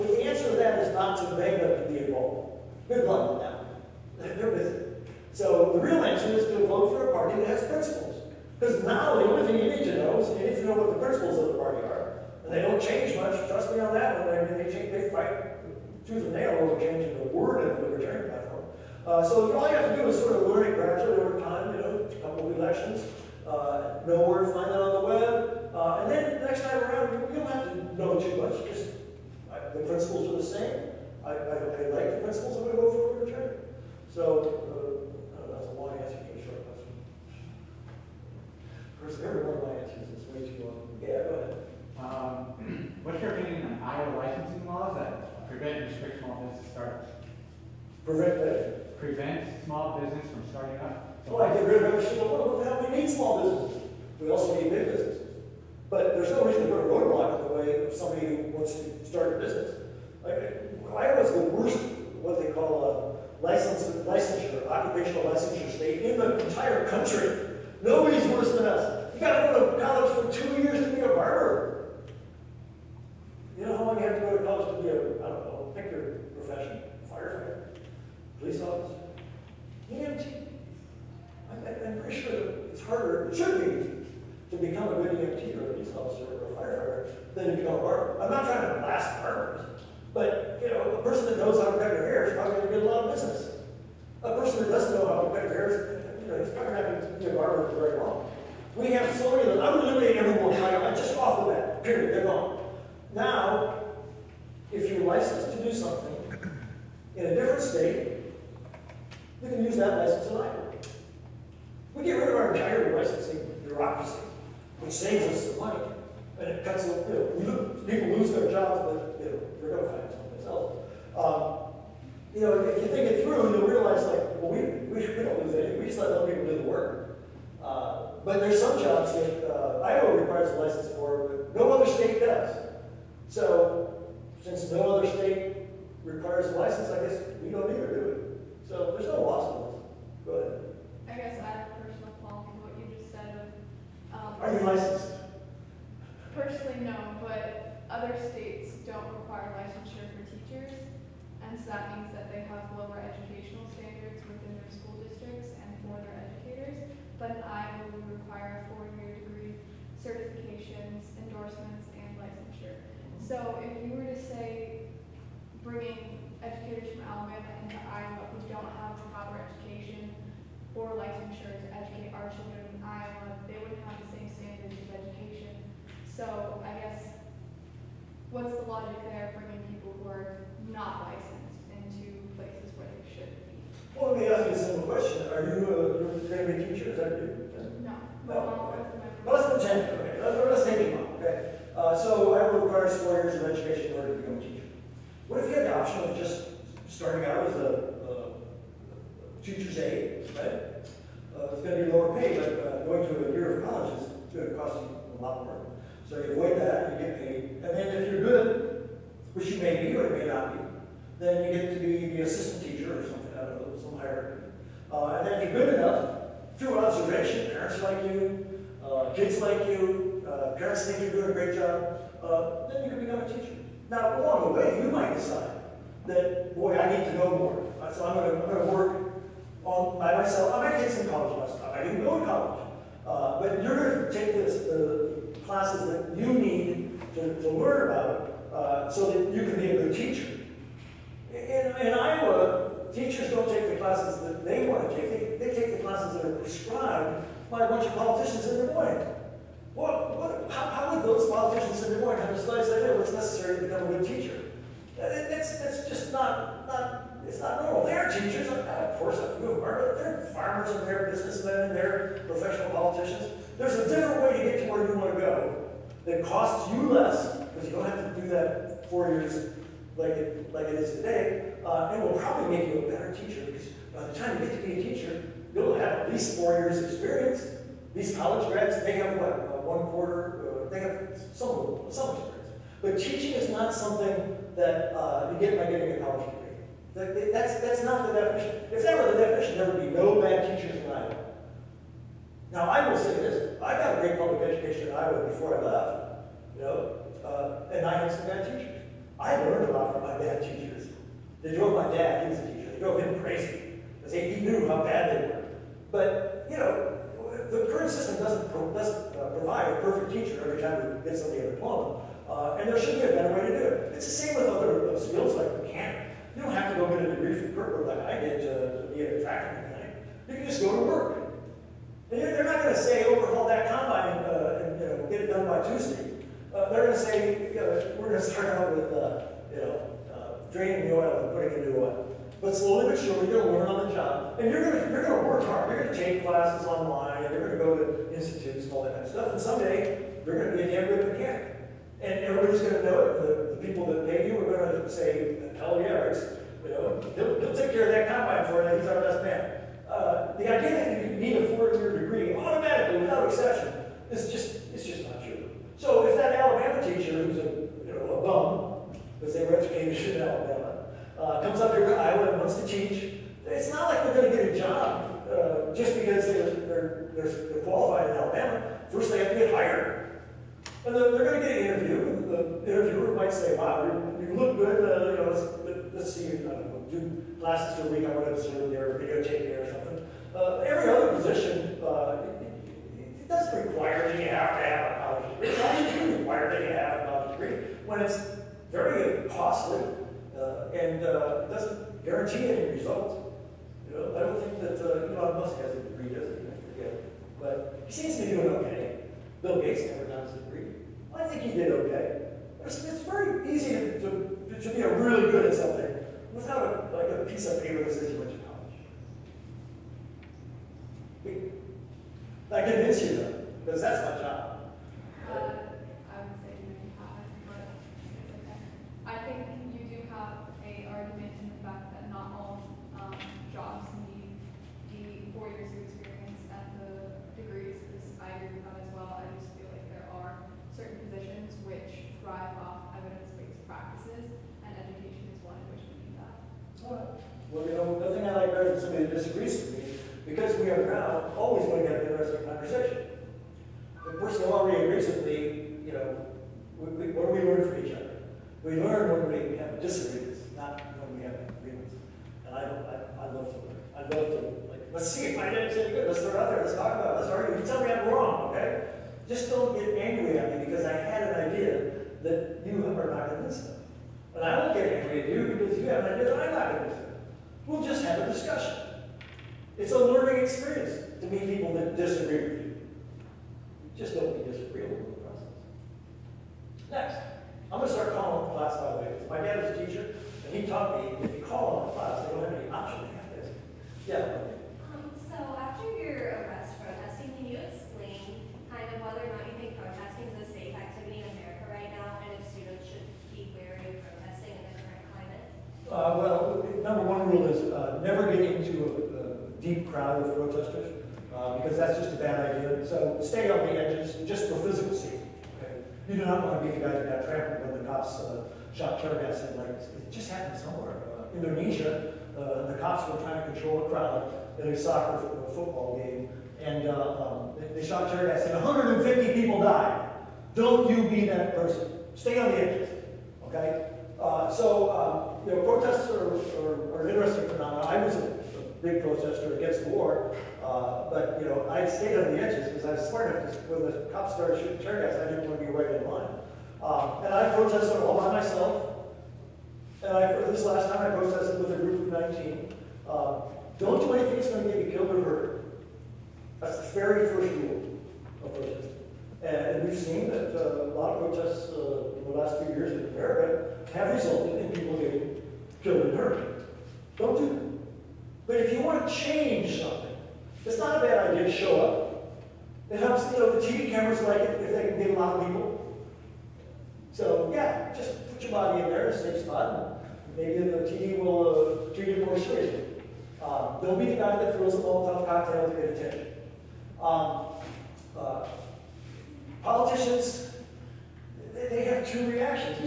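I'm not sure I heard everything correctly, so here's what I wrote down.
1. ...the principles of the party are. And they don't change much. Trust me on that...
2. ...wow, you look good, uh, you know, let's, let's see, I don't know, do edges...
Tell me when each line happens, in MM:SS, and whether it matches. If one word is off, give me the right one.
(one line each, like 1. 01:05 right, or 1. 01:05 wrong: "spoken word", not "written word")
1. 00:10 right
2. 06:13 wrong: "classes", not "edges".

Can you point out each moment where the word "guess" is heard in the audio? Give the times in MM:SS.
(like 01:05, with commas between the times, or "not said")
02:17, 02:21, 02:56.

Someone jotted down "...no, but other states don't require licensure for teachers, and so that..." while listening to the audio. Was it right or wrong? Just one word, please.
right.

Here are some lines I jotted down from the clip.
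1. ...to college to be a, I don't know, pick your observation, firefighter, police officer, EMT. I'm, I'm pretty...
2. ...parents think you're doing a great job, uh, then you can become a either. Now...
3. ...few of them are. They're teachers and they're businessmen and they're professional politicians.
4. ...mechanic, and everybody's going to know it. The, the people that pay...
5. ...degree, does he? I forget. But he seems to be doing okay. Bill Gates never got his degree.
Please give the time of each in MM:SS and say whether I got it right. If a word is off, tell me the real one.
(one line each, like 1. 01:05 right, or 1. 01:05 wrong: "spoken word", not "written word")
1. 01:14 wrong: "profession", not "observation"
2. 03:40 wrong: "teacher", not "either"
3. 04:19 wrong: "farmers", not "teachers"
4. 05:41 right
5. 06:35 right.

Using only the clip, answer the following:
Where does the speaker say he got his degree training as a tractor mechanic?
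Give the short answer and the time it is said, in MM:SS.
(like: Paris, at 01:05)
Gerber, at 05:17.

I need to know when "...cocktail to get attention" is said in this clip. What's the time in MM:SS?
09:35.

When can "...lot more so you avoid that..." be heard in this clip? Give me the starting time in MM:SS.
03:25.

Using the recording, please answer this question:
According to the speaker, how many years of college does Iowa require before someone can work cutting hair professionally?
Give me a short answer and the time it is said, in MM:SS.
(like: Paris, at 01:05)
2 years, at 01:10.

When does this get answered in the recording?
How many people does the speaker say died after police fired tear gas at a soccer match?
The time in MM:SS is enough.
08:38.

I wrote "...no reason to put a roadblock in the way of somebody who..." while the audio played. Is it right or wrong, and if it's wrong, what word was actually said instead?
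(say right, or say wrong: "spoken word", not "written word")
right.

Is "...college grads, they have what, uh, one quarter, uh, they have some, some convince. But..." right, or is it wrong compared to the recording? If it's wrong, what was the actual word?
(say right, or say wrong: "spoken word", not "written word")
wrong: "experience", not "convince".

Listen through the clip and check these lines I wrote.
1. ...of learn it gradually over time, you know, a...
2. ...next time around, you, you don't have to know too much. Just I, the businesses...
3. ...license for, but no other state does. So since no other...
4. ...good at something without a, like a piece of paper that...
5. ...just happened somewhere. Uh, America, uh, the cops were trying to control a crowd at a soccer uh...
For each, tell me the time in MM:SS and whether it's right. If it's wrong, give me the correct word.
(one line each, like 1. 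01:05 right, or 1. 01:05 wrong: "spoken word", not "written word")
1. 00:20 right
2. 00:26 wrong: "principles", not "businesses"
3. 02:10 right
4. 06:45 right
5. 08:30 wrong: "Indonesia", not "America".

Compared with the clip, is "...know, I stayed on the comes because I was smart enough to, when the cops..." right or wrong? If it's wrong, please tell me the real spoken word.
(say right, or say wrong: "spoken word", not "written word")
wrong: "edges", not "comes".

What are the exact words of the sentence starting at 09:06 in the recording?
That's the very first rule of protest.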